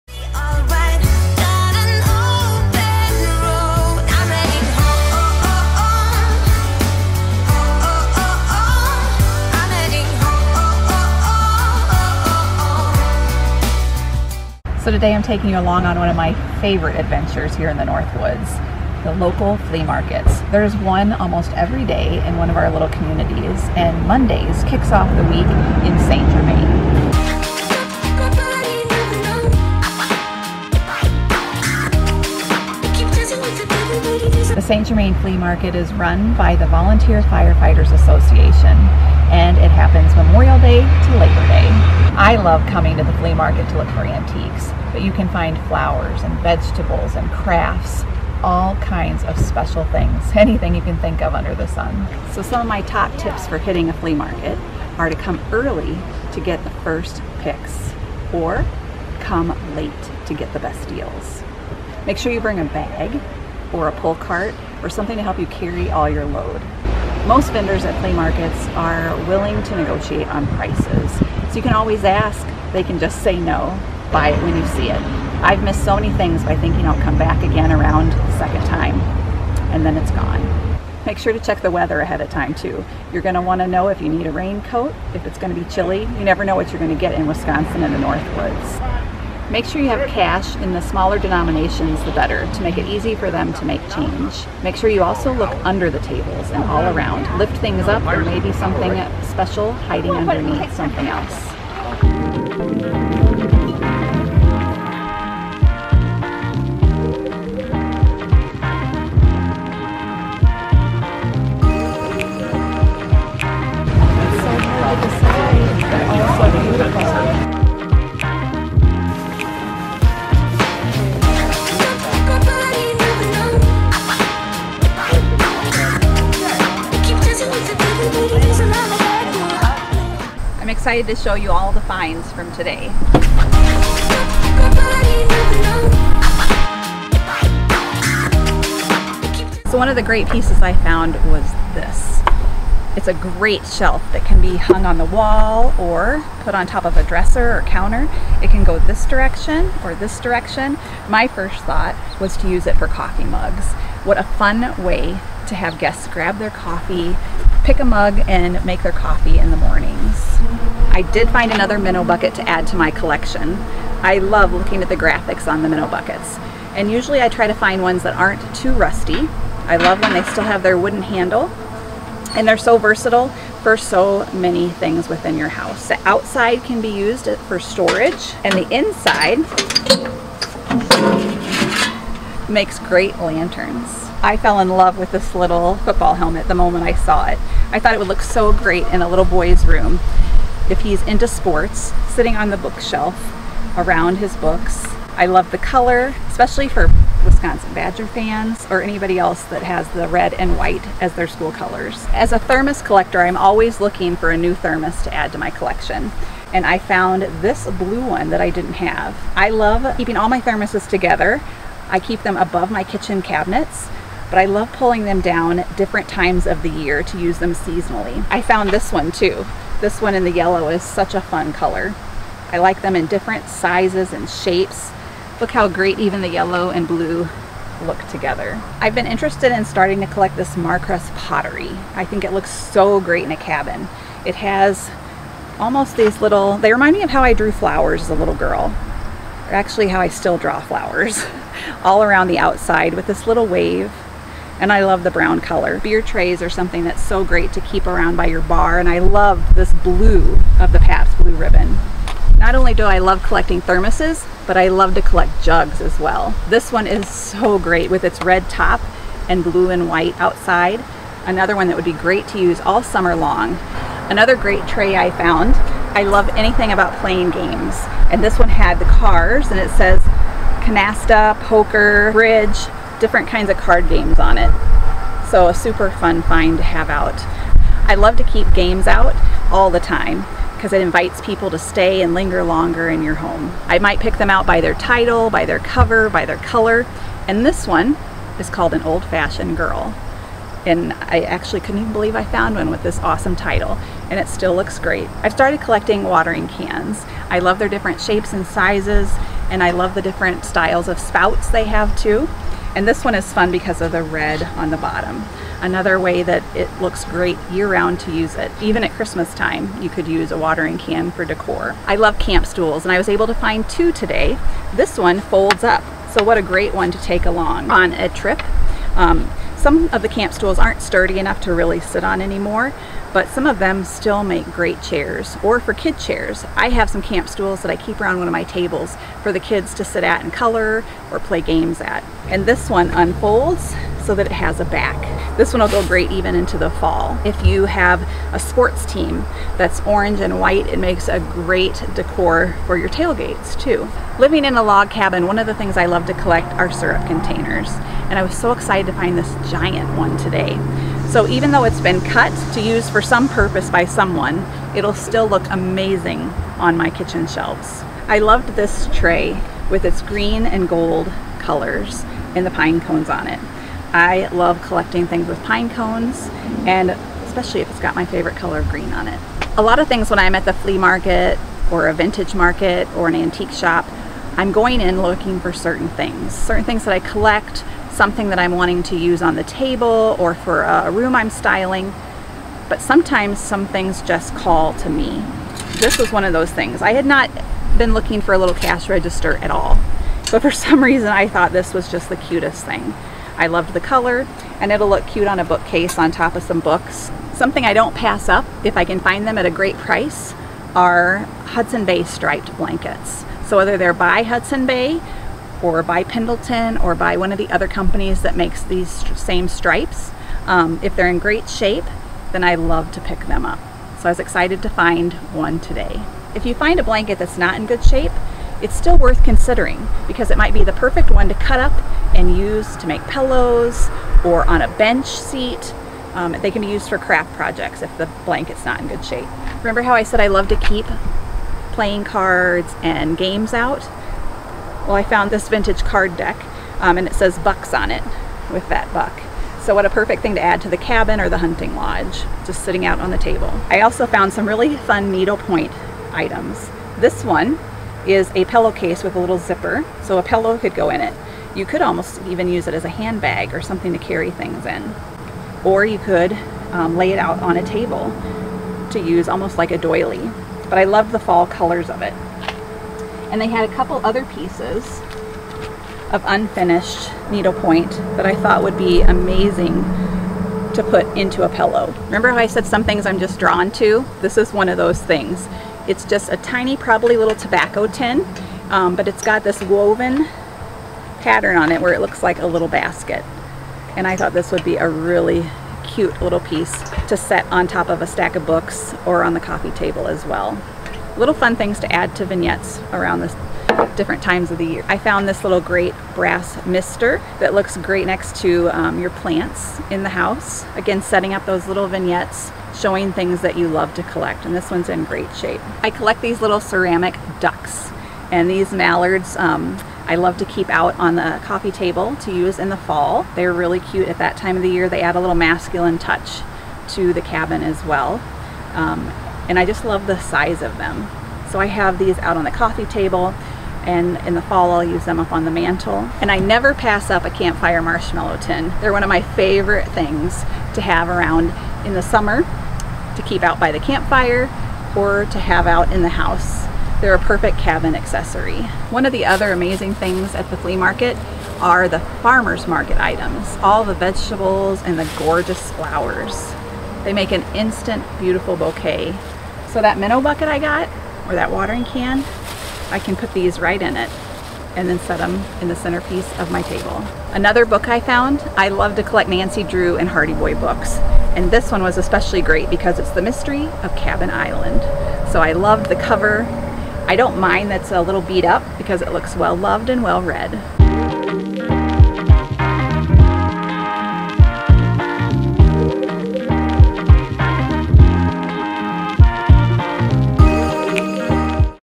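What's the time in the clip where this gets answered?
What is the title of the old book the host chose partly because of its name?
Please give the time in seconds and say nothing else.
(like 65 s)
288 s.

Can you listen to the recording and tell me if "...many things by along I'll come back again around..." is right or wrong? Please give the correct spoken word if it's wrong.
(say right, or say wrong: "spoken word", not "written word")
wrong: "thinking", not "along".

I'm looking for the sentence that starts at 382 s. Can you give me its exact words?
But sometimes some things just call to me.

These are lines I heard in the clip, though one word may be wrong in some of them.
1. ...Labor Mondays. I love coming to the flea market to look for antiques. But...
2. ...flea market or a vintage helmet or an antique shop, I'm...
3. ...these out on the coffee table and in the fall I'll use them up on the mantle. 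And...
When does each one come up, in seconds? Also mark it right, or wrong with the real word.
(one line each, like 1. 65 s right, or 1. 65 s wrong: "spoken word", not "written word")
1. 41 s wrong: "Day", not "Mondays"
2. 370 s wrong: "market", not "helmet"
3. 521 s right.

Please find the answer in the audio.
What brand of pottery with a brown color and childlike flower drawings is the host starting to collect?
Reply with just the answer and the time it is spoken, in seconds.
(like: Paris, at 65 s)
Marcrest, at 230 s.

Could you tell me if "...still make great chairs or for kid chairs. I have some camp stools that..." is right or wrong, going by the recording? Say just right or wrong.
right.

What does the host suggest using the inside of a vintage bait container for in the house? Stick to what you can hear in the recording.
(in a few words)
lanterns.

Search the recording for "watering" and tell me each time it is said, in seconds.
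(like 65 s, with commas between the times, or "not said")
296 s, 310 s, 551 s.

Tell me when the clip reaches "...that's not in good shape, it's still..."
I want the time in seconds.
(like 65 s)
417 s.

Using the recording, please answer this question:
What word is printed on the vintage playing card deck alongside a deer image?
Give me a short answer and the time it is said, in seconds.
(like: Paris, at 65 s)
bucks, at 437 s.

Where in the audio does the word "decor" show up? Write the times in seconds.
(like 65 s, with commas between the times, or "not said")
311 s, 341 s.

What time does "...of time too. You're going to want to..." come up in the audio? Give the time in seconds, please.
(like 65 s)
82 s.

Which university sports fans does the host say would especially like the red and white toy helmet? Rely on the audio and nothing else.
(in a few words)
Wisconsin Badger fans.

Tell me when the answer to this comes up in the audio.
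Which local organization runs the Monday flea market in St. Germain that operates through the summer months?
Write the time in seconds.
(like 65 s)
36 s.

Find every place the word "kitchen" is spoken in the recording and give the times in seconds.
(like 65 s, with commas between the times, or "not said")
212 s, 356 s.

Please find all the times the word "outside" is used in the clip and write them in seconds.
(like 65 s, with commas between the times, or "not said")
176 s, 242 s, 260 s.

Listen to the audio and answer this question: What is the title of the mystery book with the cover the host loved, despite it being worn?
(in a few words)
The Mystery of Cabin Island.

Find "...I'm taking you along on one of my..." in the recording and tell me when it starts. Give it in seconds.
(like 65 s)
15 s.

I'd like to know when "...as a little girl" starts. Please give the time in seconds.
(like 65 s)
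238 s.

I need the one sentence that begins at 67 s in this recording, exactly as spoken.
Most vendors at flea markets are willing to negotiate on prices.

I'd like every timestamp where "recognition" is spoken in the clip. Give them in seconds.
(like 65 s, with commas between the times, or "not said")
not said.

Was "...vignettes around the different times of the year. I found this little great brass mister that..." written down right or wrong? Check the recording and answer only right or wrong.
right.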